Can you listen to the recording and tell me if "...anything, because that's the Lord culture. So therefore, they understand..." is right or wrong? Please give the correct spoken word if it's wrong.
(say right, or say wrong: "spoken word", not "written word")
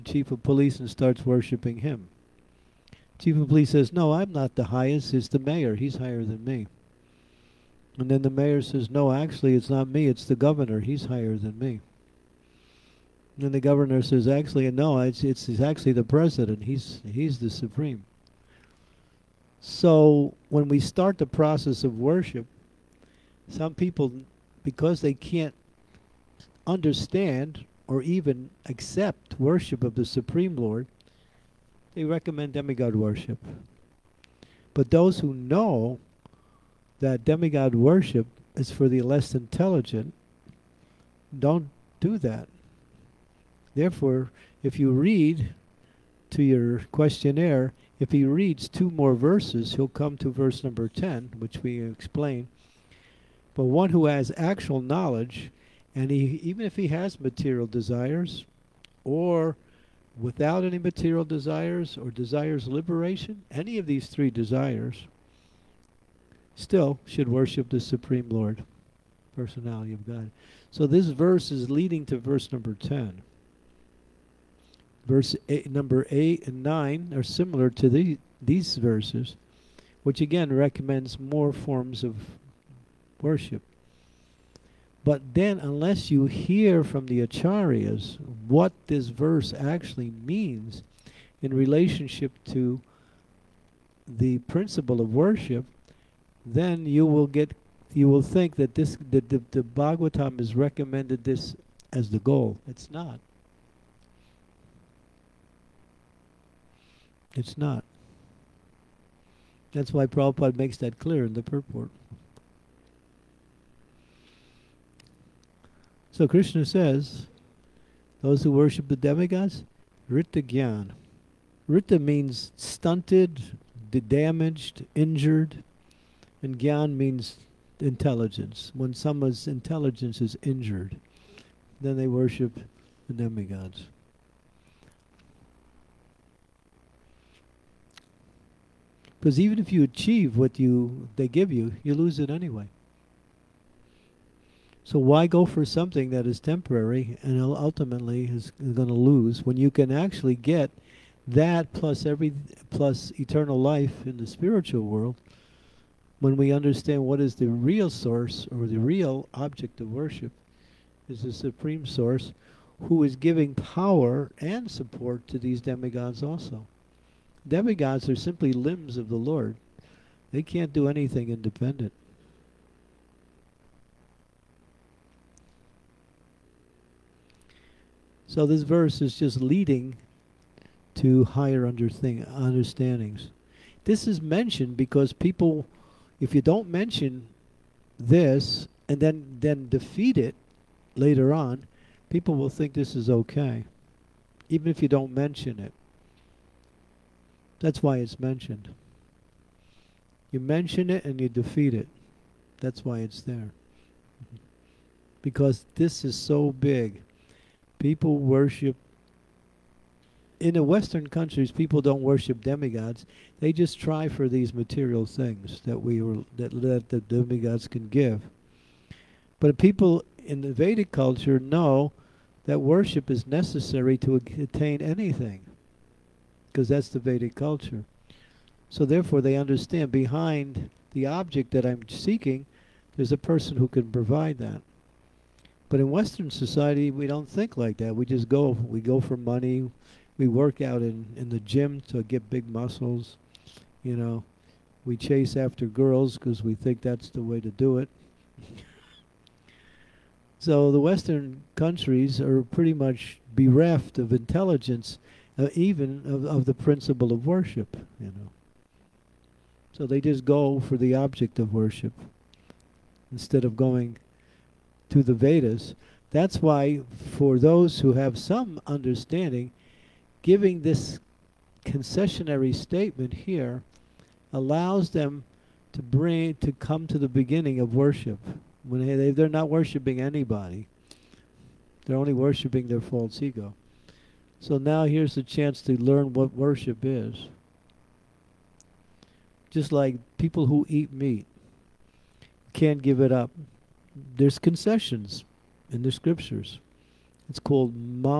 wrong: "Vedic", not "Lord".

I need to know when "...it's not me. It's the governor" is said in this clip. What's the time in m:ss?
0:09.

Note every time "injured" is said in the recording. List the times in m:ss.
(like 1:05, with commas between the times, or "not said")
2:04, 2:10.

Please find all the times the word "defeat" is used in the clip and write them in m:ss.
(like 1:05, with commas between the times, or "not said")
3:09, 3:21.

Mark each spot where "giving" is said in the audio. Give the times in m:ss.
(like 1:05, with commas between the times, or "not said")
2:43, 4:30.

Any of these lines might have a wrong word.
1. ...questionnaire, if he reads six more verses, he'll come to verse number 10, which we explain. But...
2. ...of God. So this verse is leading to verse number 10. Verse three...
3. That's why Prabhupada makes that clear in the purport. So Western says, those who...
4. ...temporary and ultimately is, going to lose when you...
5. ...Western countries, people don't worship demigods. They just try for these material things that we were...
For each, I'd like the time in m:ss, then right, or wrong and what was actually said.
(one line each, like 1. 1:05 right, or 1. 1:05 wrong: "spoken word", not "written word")
1. 0:46 wrong: "two", not "six"
2. 1:09 wrong: "eight", not "three"
3. 1:49 wrong: "Krishna", not "Western"
4. 2:26 right
5. 3:30 right.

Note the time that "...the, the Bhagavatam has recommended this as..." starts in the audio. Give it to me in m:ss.
1:39.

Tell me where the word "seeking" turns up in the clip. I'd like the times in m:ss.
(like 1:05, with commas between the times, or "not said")
3:51.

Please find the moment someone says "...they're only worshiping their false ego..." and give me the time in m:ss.
4:41.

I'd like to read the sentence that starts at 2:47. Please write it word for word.
Demigods are simply limbs of the Lord.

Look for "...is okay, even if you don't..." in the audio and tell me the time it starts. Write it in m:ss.
3:12.